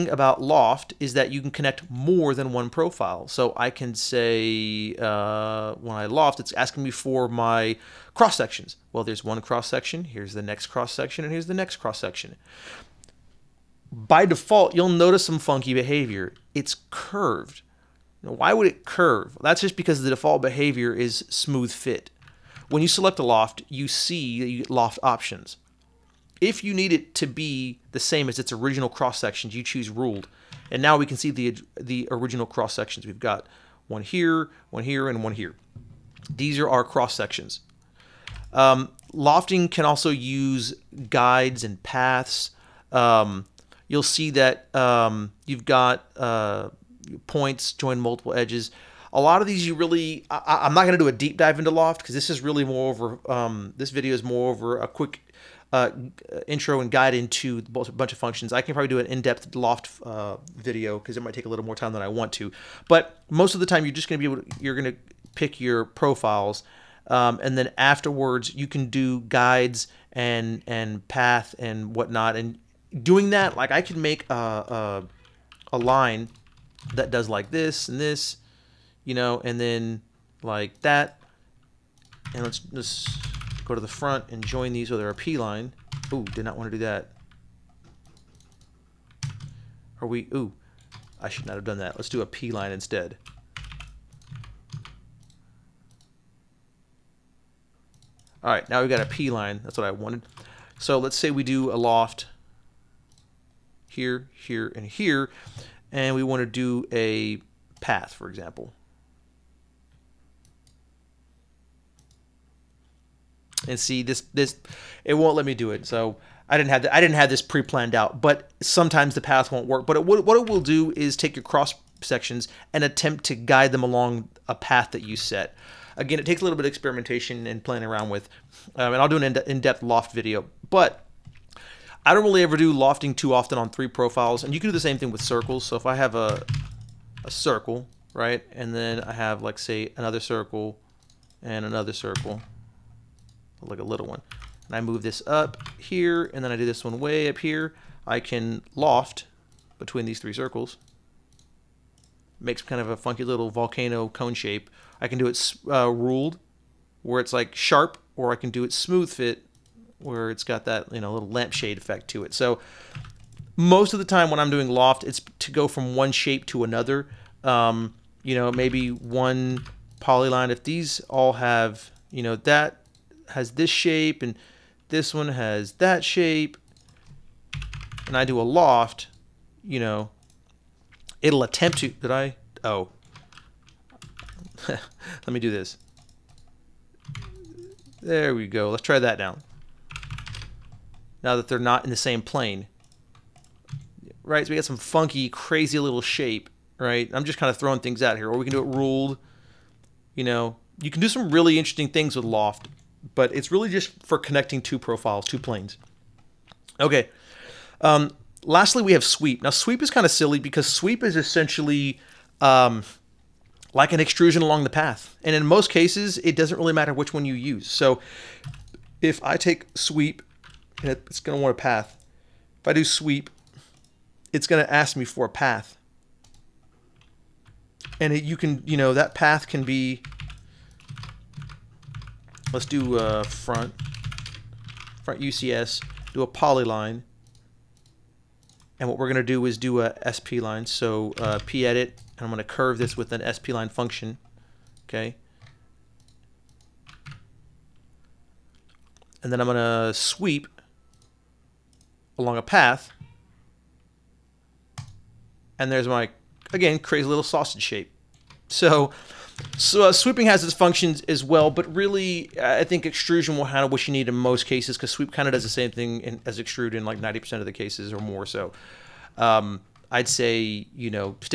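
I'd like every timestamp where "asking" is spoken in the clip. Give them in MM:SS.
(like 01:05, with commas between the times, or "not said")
00:06.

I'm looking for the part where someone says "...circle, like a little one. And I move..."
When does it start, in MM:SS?
02:21.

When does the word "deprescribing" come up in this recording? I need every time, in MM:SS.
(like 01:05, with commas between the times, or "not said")
not said.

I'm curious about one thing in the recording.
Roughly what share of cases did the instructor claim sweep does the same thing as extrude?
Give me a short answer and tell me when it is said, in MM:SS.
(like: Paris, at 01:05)
90 percent, at 04:26.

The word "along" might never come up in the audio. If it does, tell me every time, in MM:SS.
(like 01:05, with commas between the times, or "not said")
02:03, 03:34, 04:12.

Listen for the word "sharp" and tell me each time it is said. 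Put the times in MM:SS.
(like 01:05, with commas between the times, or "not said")
02:37.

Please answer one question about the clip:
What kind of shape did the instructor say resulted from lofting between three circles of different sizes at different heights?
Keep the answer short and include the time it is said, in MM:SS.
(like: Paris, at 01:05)
Volcano cone shape, at 02:33.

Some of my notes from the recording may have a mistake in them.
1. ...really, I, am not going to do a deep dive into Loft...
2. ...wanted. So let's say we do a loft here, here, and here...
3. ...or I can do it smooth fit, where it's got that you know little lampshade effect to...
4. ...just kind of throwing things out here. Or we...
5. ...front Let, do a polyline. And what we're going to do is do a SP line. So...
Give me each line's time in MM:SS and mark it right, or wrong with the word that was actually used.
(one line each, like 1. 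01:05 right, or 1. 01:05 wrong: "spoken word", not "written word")
1. 00:49 right
2. 01:39 right
3. 02:38 right
4. 03:17 right
5. 03:55 wrong: "UCS", not "Let".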